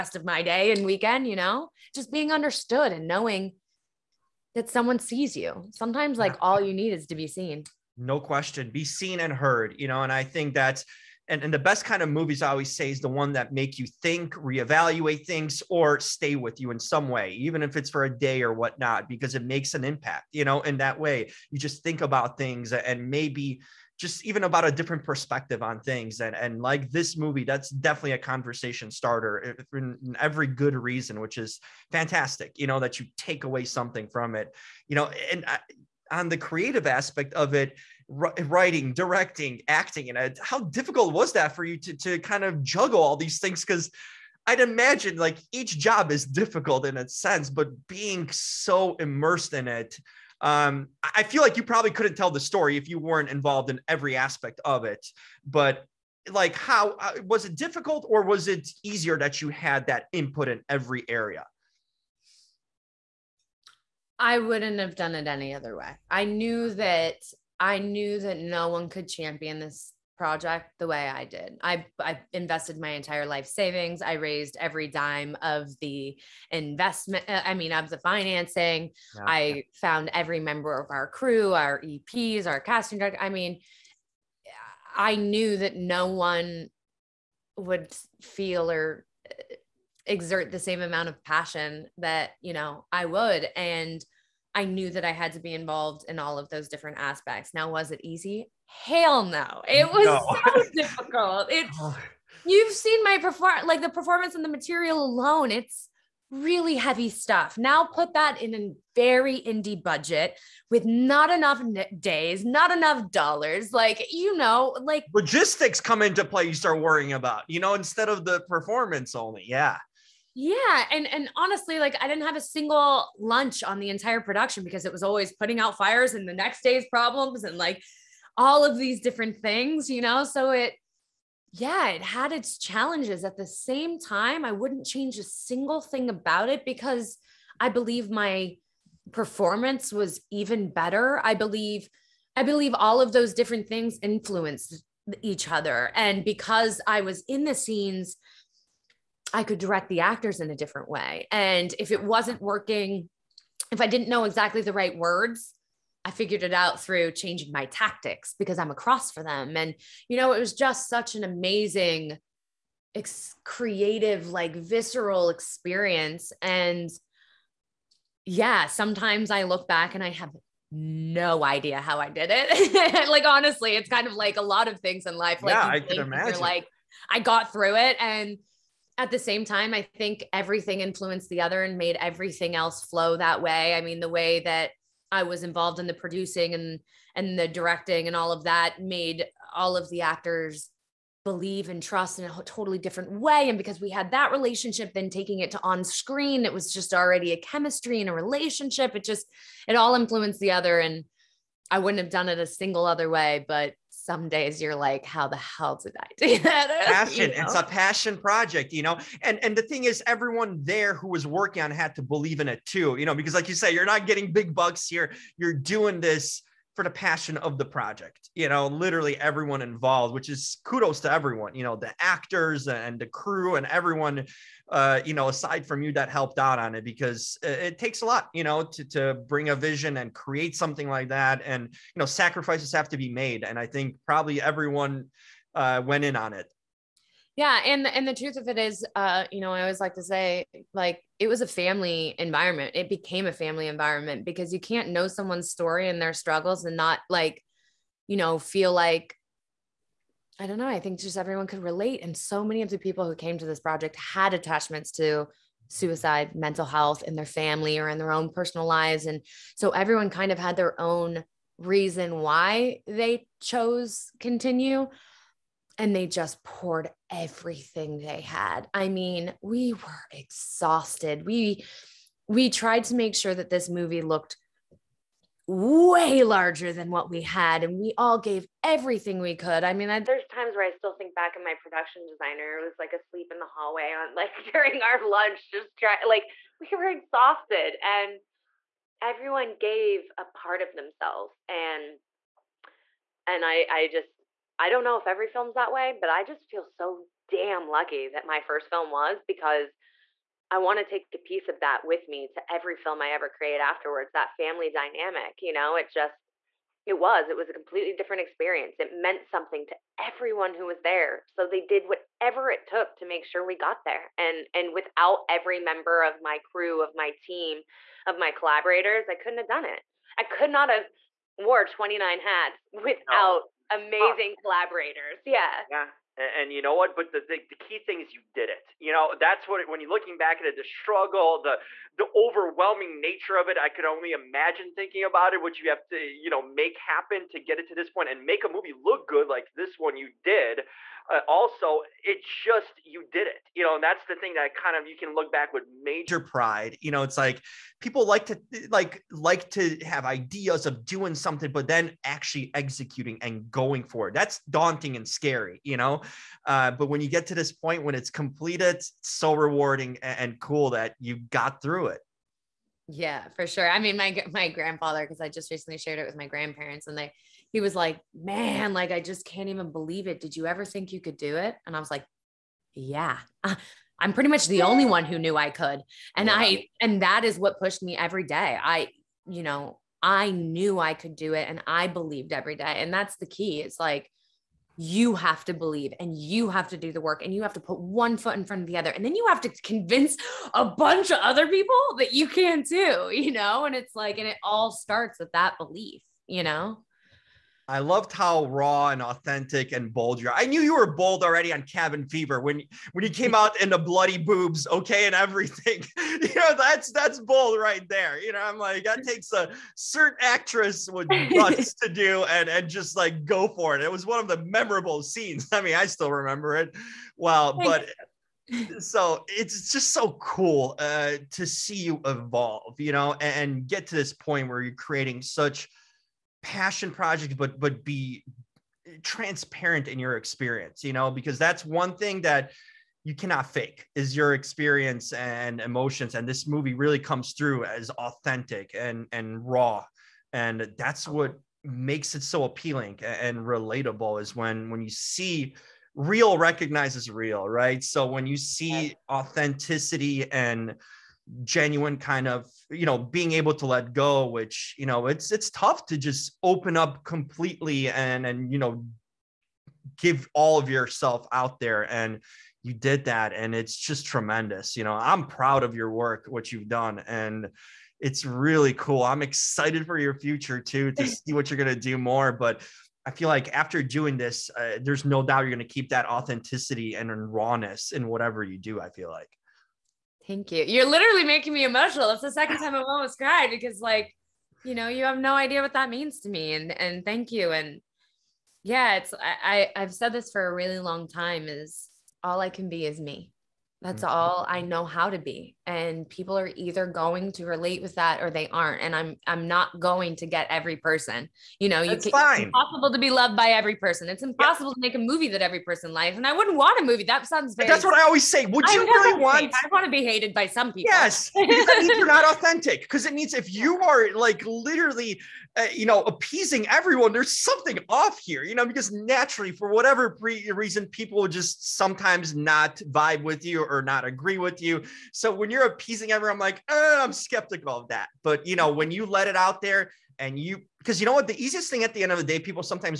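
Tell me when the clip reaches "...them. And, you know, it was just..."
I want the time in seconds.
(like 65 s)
159 s.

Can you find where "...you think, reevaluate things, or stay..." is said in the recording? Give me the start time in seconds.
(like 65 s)
13 s.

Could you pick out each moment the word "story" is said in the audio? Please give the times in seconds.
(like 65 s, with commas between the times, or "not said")
52 s, 245 s.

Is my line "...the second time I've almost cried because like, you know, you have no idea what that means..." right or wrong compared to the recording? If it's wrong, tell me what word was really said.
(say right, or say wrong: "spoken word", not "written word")
right.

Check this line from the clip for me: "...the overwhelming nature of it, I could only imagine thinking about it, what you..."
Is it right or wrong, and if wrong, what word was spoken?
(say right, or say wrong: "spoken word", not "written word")
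right.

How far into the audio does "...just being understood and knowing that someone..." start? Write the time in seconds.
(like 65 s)
1 s.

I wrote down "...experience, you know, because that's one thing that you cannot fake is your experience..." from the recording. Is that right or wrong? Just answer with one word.
right.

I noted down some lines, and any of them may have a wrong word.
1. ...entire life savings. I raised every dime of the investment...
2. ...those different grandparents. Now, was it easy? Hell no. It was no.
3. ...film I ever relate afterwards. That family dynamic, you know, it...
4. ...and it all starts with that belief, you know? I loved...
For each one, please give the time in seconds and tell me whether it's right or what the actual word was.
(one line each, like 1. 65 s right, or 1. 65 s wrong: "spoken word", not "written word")
1. 72 s right
2. 96 s wrong: "aspects", not "grandparents"
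3. 302 s wrong: "create", not "relate"
4. 394 s right.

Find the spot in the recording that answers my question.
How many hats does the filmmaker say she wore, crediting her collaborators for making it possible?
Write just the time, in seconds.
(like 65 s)
321 s.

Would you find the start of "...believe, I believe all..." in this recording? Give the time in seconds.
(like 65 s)
141 s.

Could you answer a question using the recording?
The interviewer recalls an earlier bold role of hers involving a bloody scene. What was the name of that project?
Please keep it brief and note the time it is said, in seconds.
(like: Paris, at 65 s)
Cabin Fever, at 401 s.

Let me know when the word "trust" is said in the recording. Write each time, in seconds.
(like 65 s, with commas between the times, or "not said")
191 s.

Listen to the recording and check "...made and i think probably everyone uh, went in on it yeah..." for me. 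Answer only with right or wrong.
right.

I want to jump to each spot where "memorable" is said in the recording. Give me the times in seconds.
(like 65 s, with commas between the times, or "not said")
414 s.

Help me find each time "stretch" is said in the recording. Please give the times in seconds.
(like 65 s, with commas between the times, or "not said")
not said.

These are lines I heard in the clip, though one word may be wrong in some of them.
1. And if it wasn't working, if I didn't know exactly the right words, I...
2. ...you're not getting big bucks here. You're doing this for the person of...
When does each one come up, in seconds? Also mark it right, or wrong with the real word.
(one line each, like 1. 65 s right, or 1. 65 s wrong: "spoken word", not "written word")
1. 151 s right
2. 213 s wrong: "passion", not "person".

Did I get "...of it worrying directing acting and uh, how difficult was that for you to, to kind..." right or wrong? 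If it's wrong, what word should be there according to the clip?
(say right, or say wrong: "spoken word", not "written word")
wrong: "writing", not "worrying".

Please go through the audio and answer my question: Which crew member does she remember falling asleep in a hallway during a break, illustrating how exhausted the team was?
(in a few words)
Production designer.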